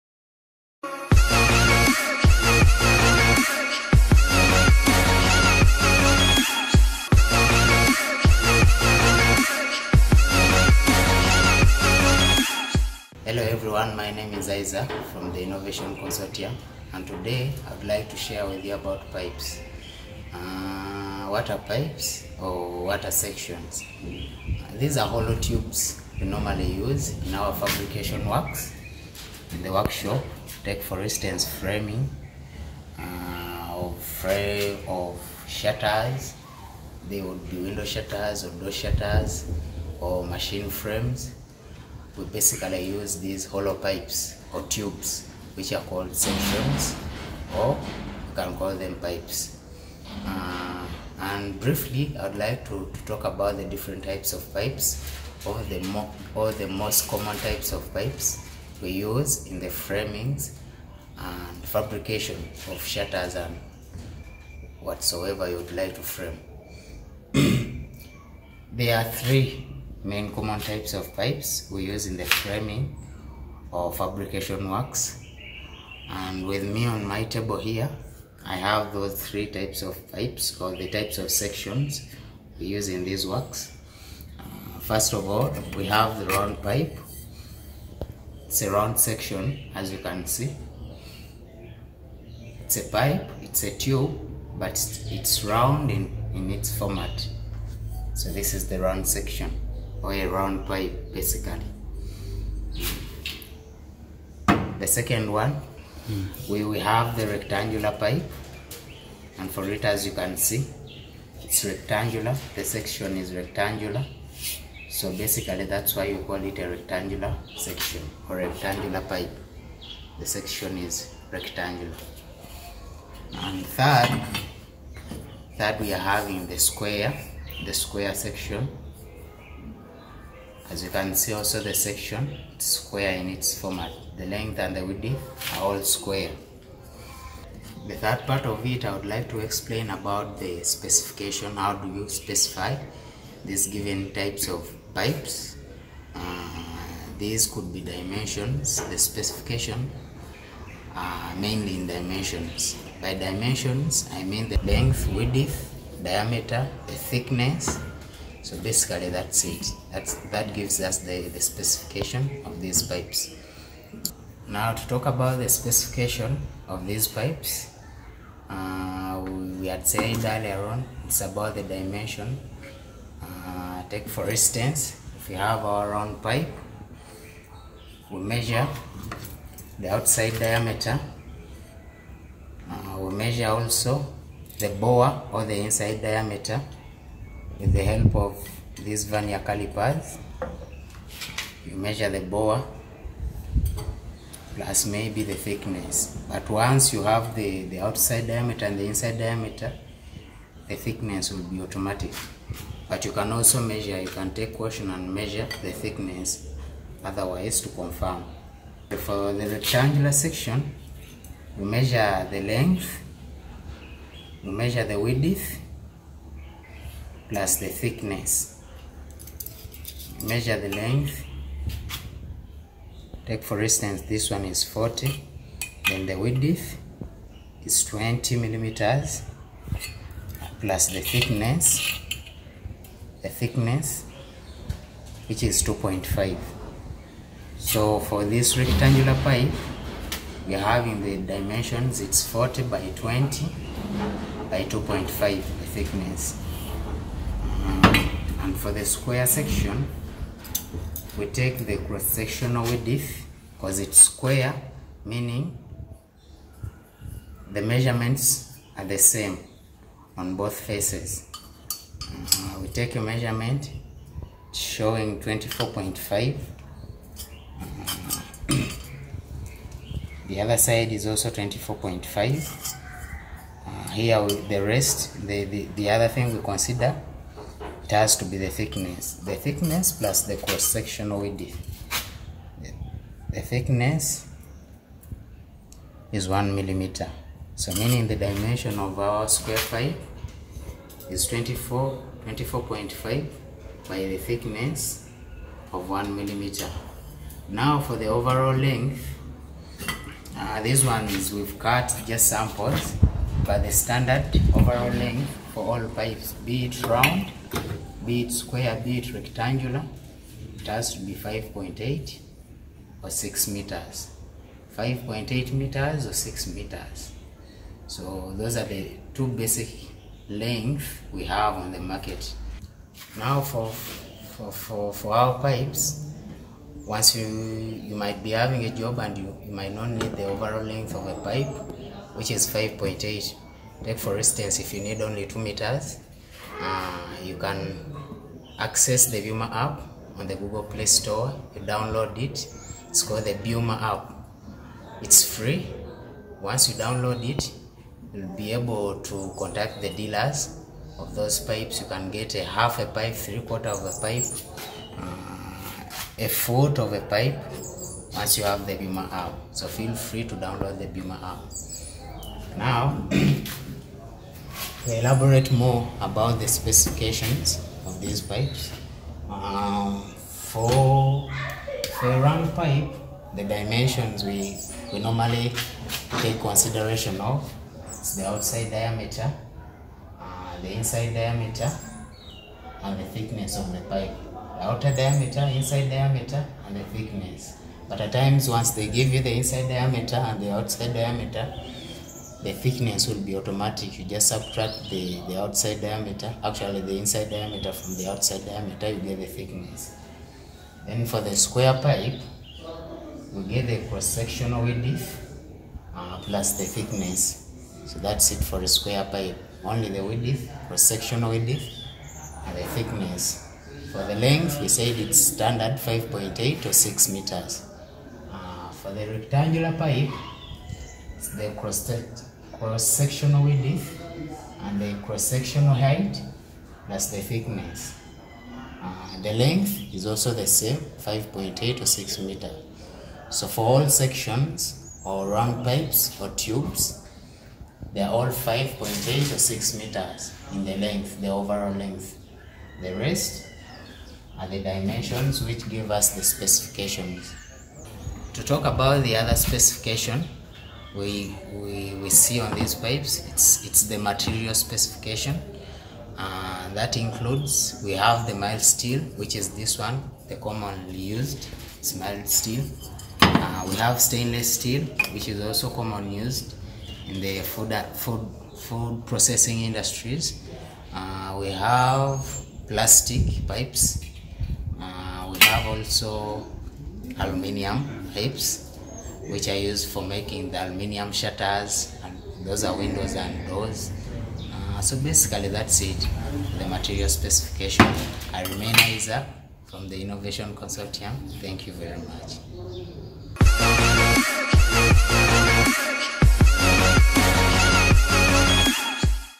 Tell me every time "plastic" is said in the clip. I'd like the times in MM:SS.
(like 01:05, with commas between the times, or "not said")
07:52.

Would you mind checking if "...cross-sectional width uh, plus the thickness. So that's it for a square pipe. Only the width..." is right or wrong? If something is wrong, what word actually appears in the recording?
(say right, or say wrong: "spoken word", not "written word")
right.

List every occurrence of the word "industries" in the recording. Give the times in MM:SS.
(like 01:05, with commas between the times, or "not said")
07:49.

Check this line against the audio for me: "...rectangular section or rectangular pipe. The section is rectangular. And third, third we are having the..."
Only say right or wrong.
right.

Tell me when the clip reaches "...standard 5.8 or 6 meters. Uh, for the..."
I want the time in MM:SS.
06:55.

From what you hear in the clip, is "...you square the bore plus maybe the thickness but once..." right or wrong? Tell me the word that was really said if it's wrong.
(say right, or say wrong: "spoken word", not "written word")
wrong: "measure", not "square".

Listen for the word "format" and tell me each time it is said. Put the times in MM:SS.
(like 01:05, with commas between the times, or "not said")
01:36, 02:13.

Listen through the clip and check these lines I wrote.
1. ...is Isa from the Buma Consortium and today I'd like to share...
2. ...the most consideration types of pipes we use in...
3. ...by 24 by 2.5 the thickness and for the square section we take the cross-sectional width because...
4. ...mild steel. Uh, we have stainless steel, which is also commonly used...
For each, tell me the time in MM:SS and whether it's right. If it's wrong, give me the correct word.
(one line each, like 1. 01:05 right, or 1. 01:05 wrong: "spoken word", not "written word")
1. 00:14 wrong: "Innovation", not "Buma"
2. 00:56 wrong: "common", not "consideration"
3. 04:02 wrong: "20", not "24"
4. 07:41 right.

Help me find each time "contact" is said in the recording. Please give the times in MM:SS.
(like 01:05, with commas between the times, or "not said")
05:49.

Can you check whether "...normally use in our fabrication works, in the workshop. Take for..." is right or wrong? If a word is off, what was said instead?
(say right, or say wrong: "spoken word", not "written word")
right.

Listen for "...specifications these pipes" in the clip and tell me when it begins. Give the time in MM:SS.
06:06.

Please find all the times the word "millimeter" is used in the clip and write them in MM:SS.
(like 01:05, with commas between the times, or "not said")
03:48, 04:46, 04:56.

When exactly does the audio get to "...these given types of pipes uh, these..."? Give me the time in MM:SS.
02:23.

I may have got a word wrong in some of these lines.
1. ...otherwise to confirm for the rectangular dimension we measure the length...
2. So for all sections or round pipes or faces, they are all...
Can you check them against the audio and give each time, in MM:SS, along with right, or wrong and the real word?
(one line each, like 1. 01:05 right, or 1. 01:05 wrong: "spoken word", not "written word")
1. 03:27 wrong: "section", not "dimension"
2. 07:13 wrong: "tubes", not "faces".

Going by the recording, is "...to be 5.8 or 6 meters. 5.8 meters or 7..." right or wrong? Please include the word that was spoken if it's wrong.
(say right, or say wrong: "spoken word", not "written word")
wrong: "6", not "7".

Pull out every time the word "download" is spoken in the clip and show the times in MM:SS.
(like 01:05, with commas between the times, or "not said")
05:41, 05:46, 06:00.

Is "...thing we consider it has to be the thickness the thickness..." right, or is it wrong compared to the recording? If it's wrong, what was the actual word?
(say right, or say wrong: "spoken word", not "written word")
right.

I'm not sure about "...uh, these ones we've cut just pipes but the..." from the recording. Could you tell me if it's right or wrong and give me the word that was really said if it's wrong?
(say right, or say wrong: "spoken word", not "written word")
wrong: "samples", not "pipes".